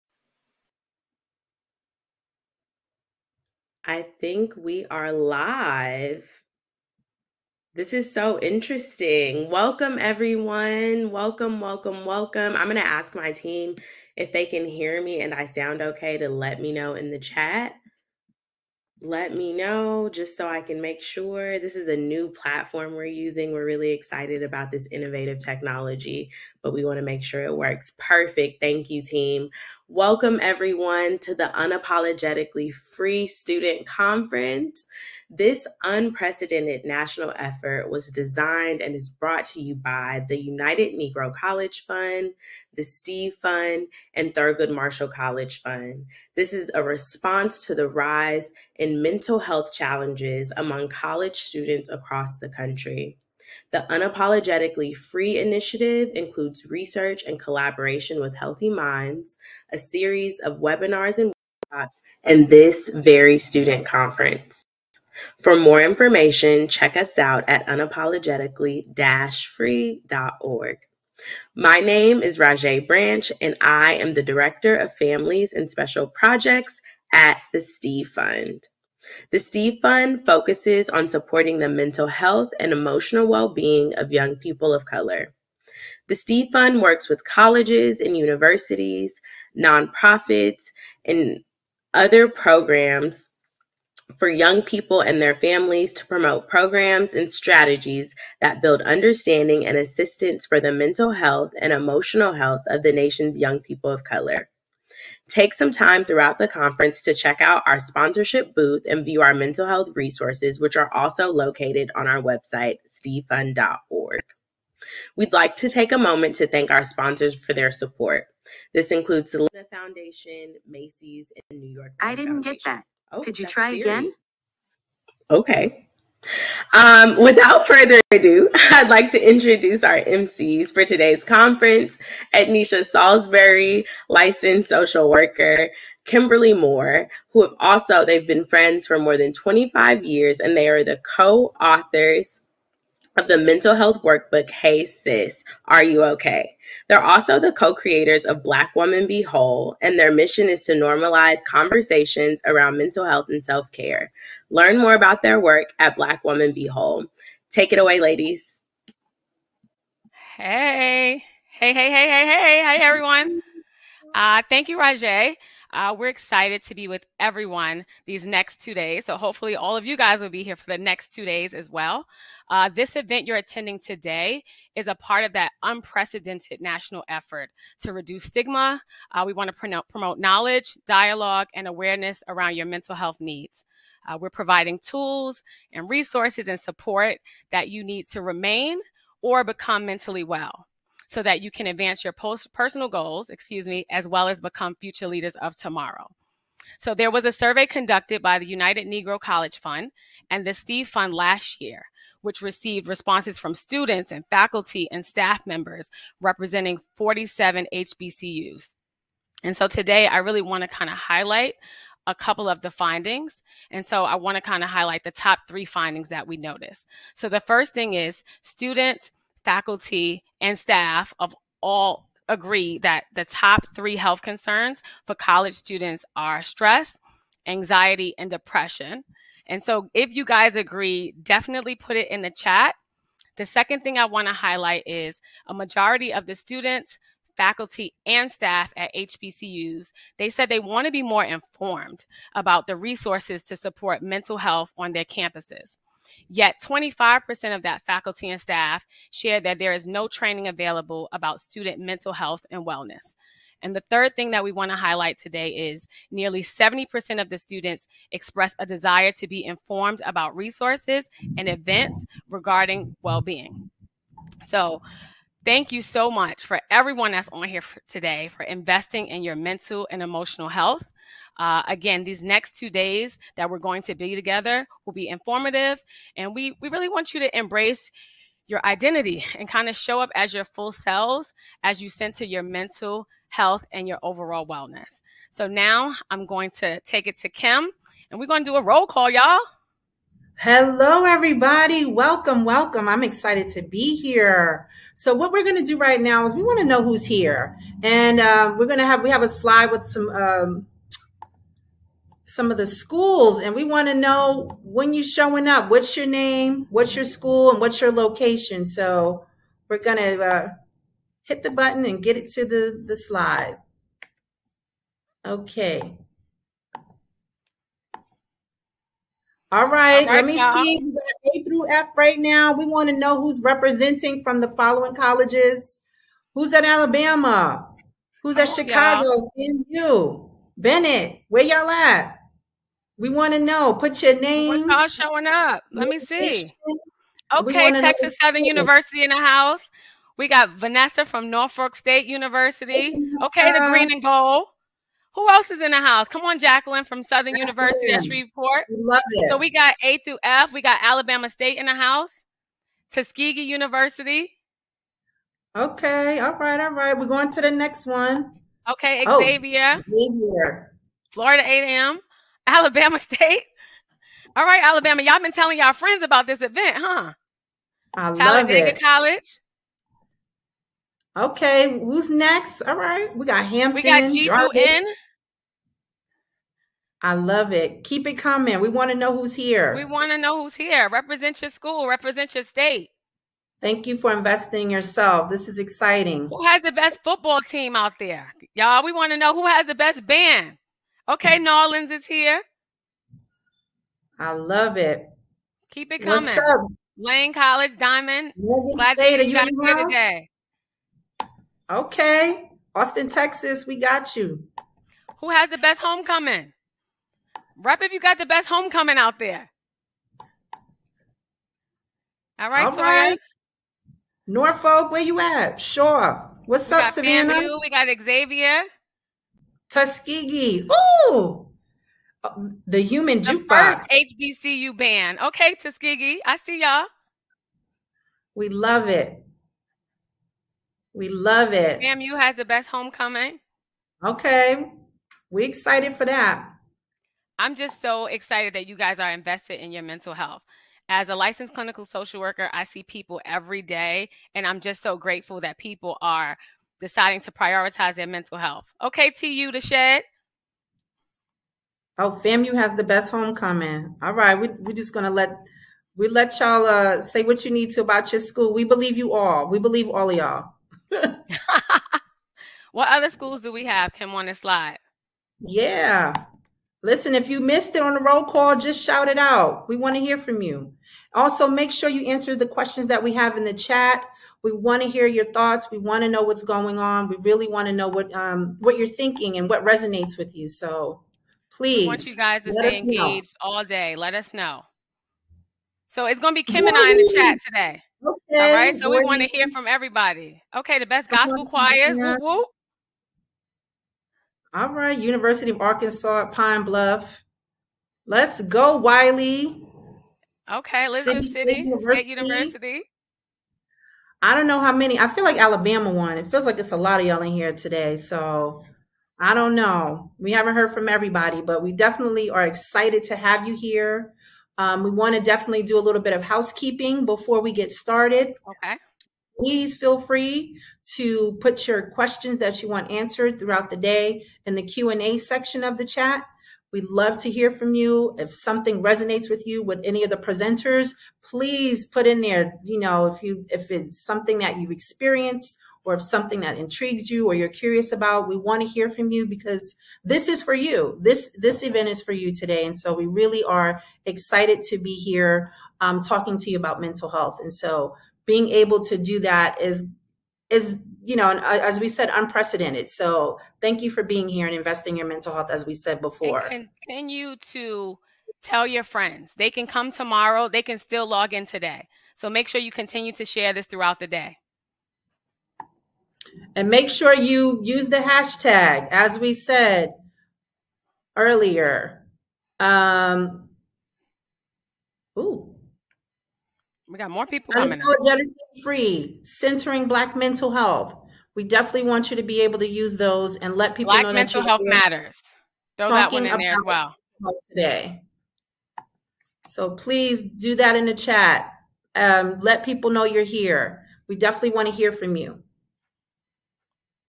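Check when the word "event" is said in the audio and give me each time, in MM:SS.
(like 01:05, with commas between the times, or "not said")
02:52, 04:21, 06:06, 09:01.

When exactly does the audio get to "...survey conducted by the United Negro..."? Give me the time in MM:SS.
03:17.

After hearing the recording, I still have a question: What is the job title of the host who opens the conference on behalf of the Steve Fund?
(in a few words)
Director of Families and Special Projects.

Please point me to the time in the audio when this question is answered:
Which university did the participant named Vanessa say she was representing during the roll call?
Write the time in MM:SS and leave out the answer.
05:41.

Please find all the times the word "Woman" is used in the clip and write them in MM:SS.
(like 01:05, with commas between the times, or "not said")
02:28, 02:36.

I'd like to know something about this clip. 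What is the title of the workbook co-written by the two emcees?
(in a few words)
Hey Sis, Are You Okay?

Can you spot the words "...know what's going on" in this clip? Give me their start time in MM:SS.
07:56.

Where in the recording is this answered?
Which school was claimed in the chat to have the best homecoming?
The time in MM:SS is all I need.
07:32.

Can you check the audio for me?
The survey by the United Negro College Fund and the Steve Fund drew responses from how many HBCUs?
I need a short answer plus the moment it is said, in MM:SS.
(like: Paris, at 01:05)
47, at 03:26.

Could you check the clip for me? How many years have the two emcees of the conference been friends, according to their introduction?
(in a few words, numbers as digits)
25.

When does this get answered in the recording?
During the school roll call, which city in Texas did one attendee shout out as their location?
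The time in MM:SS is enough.
06:42.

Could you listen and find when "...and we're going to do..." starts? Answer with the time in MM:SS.
04:48.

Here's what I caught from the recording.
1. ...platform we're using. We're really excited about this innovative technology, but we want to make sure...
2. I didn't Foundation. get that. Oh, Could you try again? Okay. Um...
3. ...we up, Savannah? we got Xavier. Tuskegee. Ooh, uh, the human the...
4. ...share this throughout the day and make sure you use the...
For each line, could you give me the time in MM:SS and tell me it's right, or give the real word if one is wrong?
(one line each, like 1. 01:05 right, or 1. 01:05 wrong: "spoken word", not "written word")
1. 00:22 right
2. 02:02 right
3. 06:56 right
4. 09:23 right.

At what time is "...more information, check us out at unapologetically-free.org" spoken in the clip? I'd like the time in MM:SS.
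01:05.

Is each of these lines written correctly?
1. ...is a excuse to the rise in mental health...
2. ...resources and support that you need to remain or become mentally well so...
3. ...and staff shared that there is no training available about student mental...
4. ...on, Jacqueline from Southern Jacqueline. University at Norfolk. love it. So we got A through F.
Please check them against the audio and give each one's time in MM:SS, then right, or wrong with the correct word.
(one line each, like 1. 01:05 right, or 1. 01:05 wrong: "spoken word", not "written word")
1. 00:46 wrong: "response", not "excuse"
2. 03:05 right
3. 04:08 right
4. 05:46 wrong: "Shreveport", not "Norfolk".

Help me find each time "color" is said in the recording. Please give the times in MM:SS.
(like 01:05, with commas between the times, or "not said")
01:24, 01:44.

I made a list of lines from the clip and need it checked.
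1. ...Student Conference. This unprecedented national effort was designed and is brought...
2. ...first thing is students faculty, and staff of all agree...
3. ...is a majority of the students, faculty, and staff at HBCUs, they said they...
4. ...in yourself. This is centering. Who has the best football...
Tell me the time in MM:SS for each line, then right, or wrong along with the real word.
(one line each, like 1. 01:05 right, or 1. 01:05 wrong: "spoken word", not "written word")
1. 00:33 right
2. 03:37 right
3. 03:54 right
4. 06:24 wrong: "exciting", not "centering".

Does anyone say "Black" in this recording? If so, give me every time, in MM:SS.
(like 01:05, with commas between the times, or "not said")
02:28, 02:35, 09:39, 09:43.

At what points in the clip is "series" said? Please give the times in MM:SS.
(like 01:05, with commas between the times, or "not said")
00:59.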